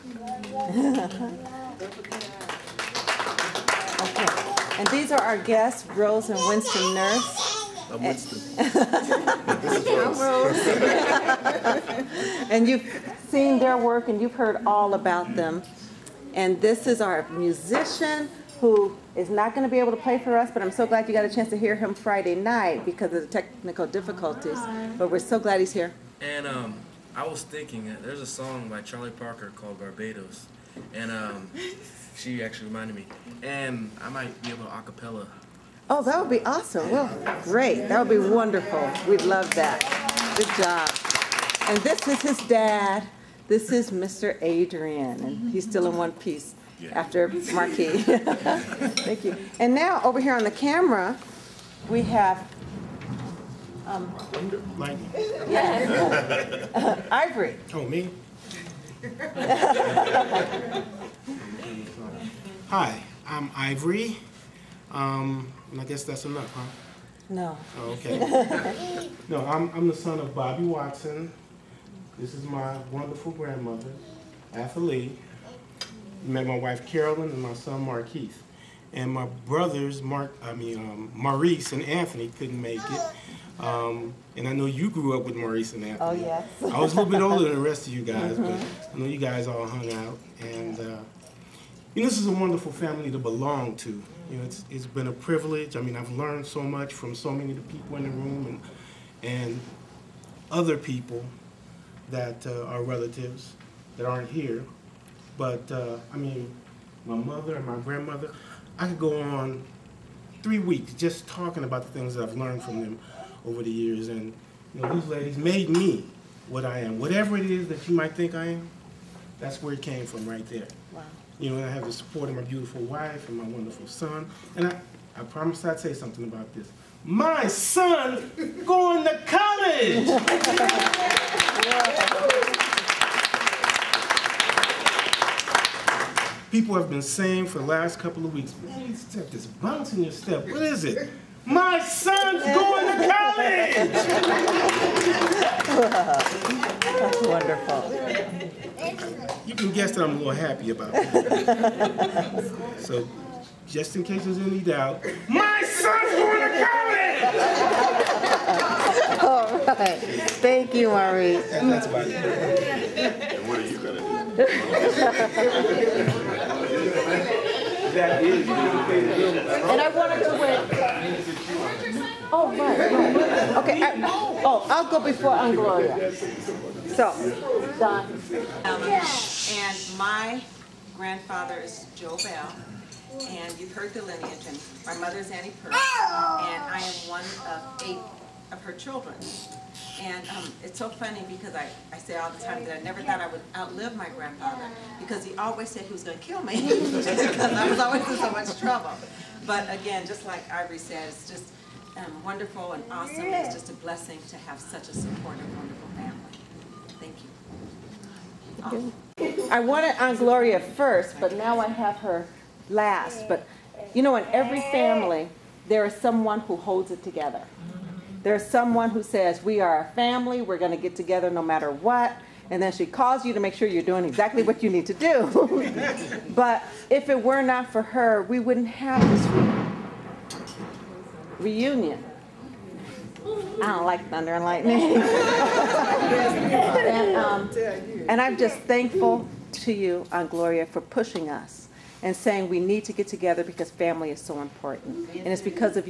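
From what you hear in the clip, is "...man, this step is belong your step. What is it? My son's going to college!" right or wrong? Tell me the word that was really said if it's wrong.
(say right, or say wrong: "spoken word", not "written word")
wrong: "bouncing", not "belong".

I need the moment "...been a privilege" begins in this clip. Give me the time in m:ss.
1:34.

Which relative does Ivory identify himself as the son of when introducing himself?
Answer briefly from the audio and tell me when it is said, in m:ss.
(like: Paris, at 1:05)
Bobby Watson, at 1:10.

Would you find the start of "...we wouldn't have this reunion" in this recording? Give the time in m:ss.
3:48.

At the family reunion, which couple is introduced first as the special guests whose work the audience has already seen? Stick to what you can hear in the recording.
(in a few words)
Rose and Winston Nurse.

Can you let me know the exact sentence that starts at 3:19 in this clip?
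But again, just like Ivory said, it's just um, wonderful and awesome.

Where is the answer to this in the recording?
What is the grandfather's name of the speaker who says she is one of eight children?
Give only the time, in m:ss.
3:01.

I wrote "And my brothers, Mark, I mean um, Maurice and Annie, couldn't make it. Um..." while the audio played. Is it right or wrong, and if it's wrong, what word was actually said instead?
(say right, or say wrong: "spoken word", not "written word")
wrong: "Anthony", not "Annie".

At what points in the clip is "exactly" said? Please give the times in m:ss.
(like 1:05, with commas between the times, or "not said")
3:44.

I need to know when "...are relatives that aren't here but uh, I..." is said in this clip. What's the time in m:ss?
1:42.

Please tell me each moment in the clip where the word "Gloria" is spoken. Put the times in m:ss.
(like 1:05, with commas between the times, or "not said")
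3:30, 4:00.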